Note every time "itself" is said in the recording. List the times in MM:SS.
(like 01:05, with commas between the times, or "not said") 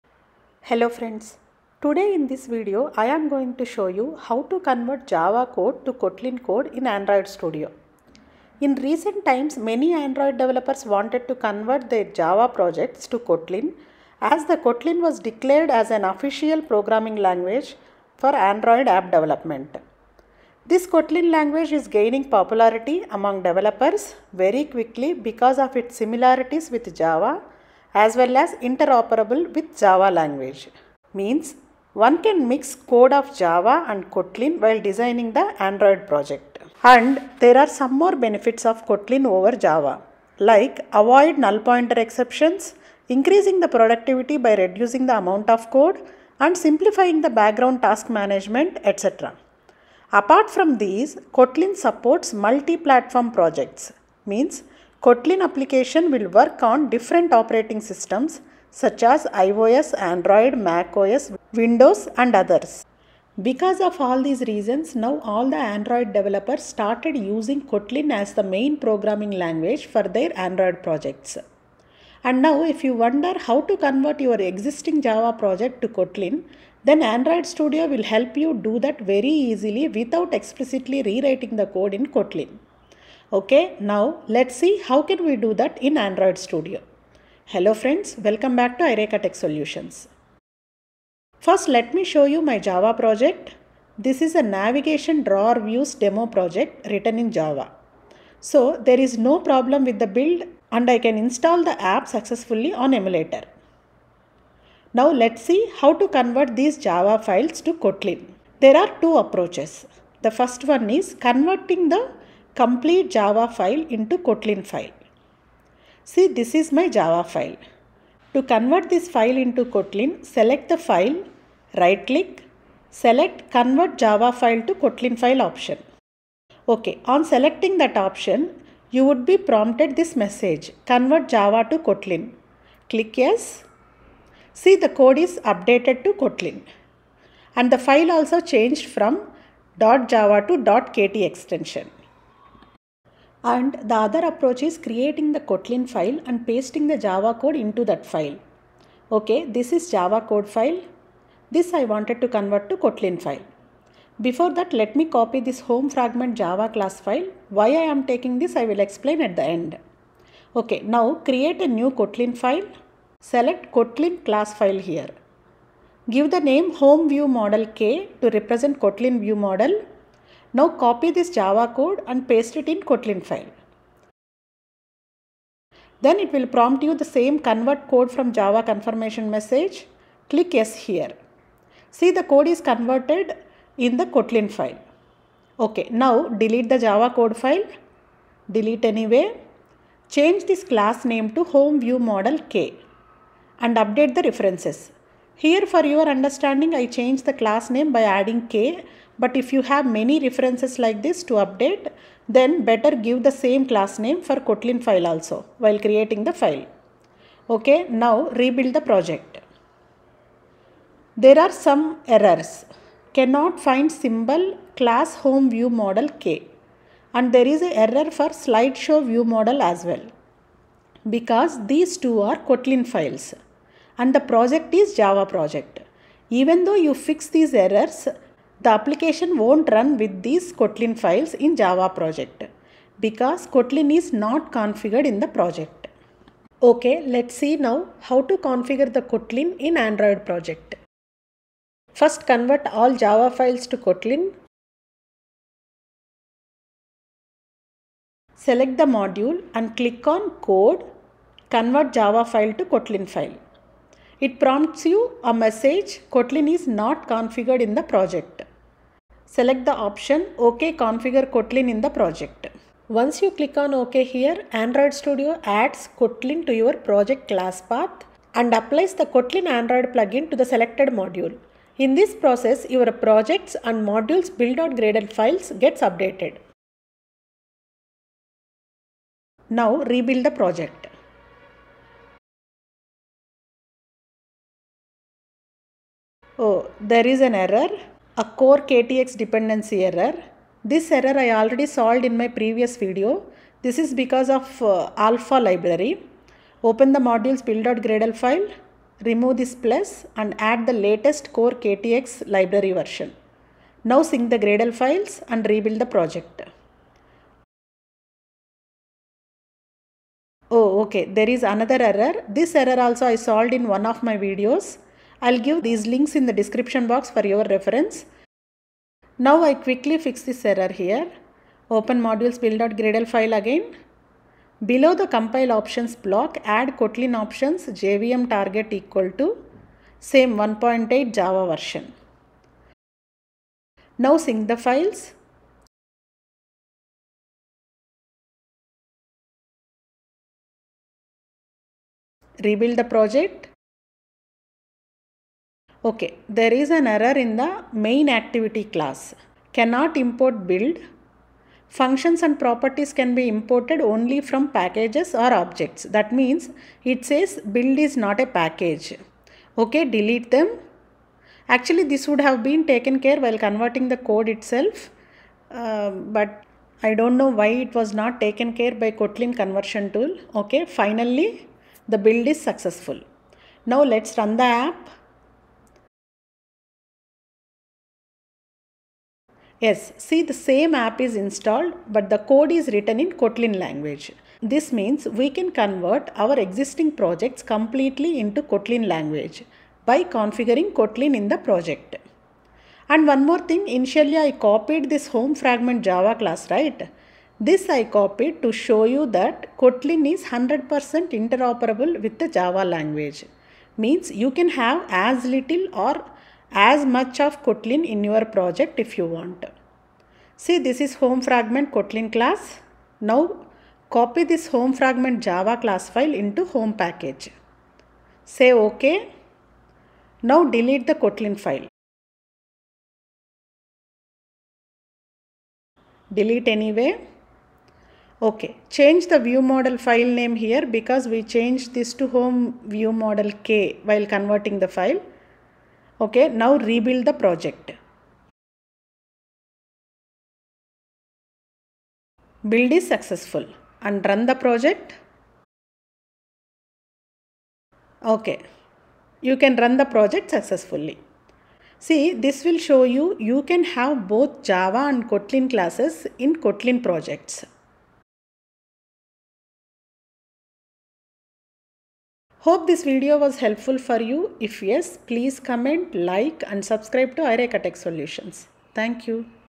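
06:04.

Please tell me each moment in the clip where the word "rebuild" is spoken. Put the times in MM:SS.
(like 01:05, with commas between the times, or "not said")
03:28, 04:39, 05:05, 05:42, 07:16.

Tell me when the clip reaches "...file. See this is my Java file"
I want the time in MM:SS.
01:54.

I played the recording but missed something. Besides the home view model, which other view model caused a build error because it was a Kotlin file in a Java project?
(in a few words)
Slideshow view model.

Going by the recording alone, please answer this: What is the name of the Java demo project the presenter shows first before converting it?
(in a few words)
Navigation drawer views demo.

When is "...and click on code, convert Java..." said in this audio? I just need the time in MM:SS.
04:09.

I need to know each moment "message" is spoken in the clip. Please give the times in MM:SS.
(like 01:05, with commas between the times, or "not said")
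02:10, 02:59, 04:15.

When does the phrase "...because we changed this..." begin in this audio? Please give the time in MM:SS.
07:10.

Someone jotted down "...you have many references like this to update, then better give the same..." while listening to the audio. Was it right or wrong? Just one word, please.
right.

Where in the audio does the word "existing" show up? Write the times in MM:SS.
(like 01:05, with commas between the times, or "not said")
01:14, 06:26.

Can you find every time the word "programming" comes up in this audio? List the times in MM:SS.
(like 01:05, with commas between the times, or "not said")
00:16, 01:08.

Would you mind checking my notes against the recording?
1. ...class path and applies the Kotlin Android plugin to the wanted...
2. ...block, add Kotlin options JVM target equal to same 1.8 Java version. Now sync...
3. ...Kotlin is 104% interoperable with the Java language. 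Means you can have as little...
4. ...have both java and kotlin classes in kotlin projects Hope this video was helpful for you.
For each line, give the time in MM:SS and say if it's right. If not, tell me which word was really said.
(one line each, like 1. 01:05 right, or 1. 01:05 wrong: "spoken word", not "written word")
1. 04:27 wrong: "selected", not "wanted"
2. 05:25 right
3. 06:39 wrong: "100", not "104"
4. 07:33 right.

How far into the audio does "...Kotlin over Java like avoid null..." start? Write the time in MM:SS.
00:38.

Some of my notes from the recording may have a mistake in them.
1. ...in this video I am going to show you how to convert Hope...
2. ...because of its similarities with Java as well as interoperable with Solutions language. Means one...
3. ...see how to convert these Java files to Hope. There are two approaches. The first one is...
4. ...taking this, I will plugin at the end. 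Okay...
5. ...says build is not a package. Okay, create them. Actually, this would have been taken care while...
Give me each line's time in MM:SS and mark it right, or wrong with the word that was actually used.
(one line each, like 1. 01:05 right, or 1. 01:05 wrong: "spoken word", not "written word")
1. 00:02 wrong: "Java", not "Hope"
2. 00:25 wrong: "Java", not "Solutions"
3. 01:45 wrong: "Kotlin", not "Hope"
4. 02:38 wrong: "explain", not "plugin"
5. 05:57 wrong: "delete", not "create".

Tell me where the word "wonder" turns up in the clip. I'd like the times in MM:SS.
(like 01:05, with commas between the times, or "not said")
01:12.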